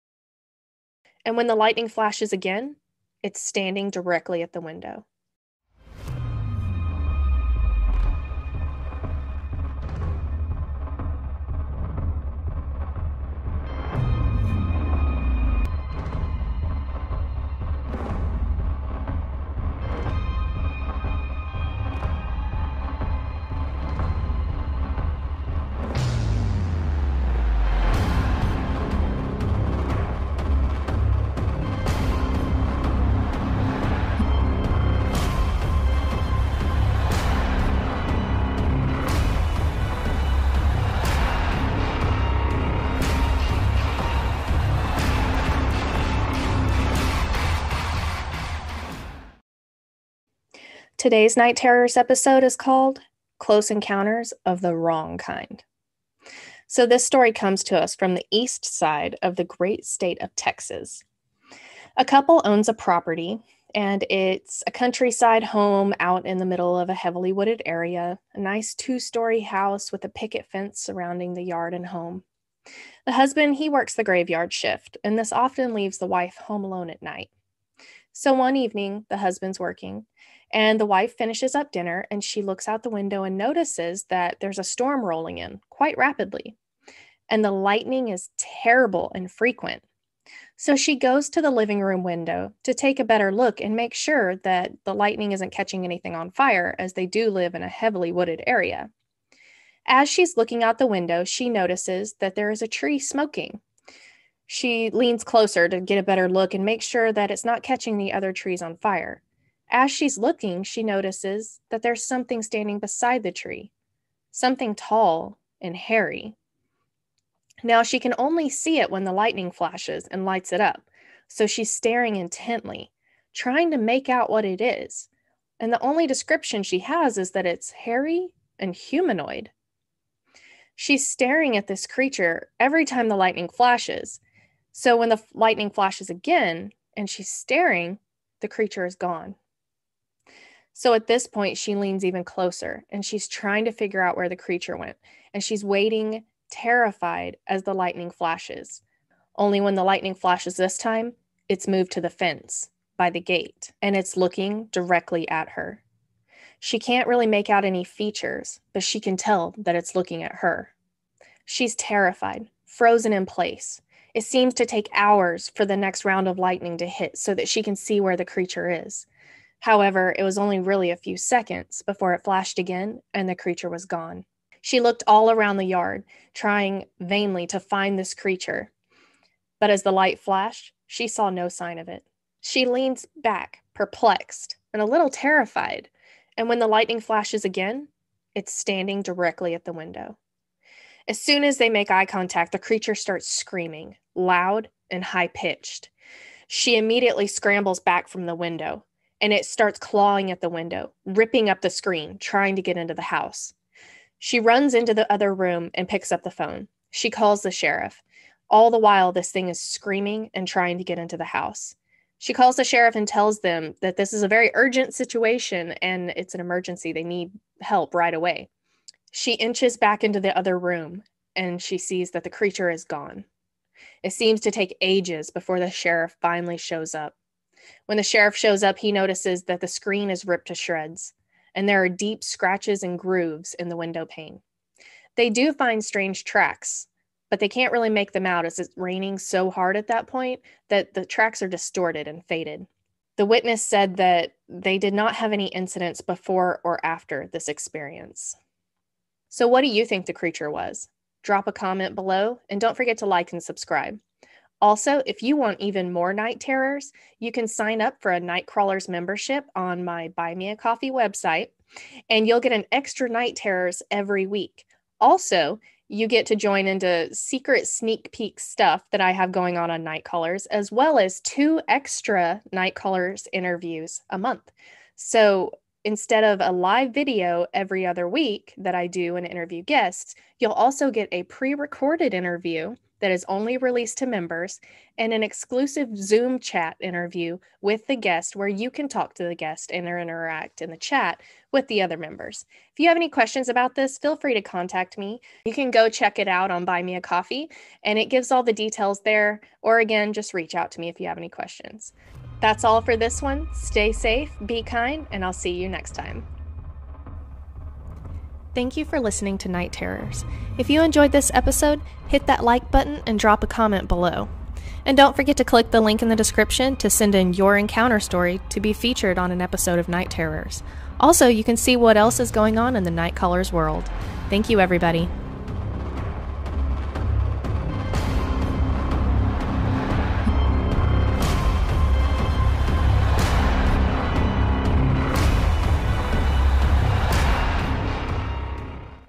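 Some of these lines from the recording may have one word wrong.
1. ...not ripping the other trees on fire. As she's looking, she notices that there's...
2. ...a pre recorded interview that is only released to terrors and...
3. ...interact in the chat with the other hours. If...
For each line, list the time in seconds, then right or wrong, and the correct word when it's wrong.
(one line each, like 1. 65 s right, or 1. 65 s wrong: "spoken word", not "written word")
1. 107 s wrong: "catching", not "ripping"
2. 281 s wrong: "members", not "terrors"
3. 289 s wrong: "members", not "hours".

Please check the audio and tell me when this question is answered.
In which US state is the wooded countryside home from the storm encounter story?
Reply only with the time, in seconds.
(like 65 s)
60 s.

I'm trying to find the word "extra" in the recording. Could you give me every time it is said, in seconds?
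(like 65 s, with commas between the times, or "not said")
262 s, 271 s.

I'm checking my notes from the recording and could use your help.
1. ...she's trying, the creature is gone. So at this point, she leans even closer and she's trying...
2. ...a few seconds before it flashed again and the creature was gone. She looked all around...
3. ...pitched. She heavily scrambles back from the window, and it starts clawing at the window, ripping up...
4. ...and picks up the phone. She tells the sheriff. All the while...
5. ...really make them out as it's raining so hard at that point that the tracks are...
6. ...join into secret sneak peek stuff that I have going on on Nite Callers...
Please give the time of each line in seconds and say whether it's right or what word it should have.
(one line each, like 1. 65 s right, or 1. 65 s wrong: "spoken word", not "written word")
1. 137 s wrong: "staring", not "trying"
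2. 170 s right
3. 195 s wrong: "immediately", not "heavily"
4. 205 s wrong: "calls", not "tells"
5. 237 s right
6. 266 s right.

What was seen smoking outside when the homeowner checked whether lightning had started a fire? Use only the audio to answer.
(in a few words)
A tree.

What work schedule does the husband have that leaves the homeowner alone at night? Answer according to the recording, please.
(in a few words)
Graveyard shift.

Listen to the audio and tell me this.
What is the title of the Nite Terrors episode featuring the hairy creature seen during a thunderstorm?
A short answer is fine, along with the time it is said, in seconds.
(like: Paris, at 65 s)
Close Encounters of the Wrong Kind, at 53 s.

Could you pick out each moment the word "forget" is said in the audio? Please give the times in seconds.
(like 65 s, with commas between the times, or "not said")
252 s, 315 s.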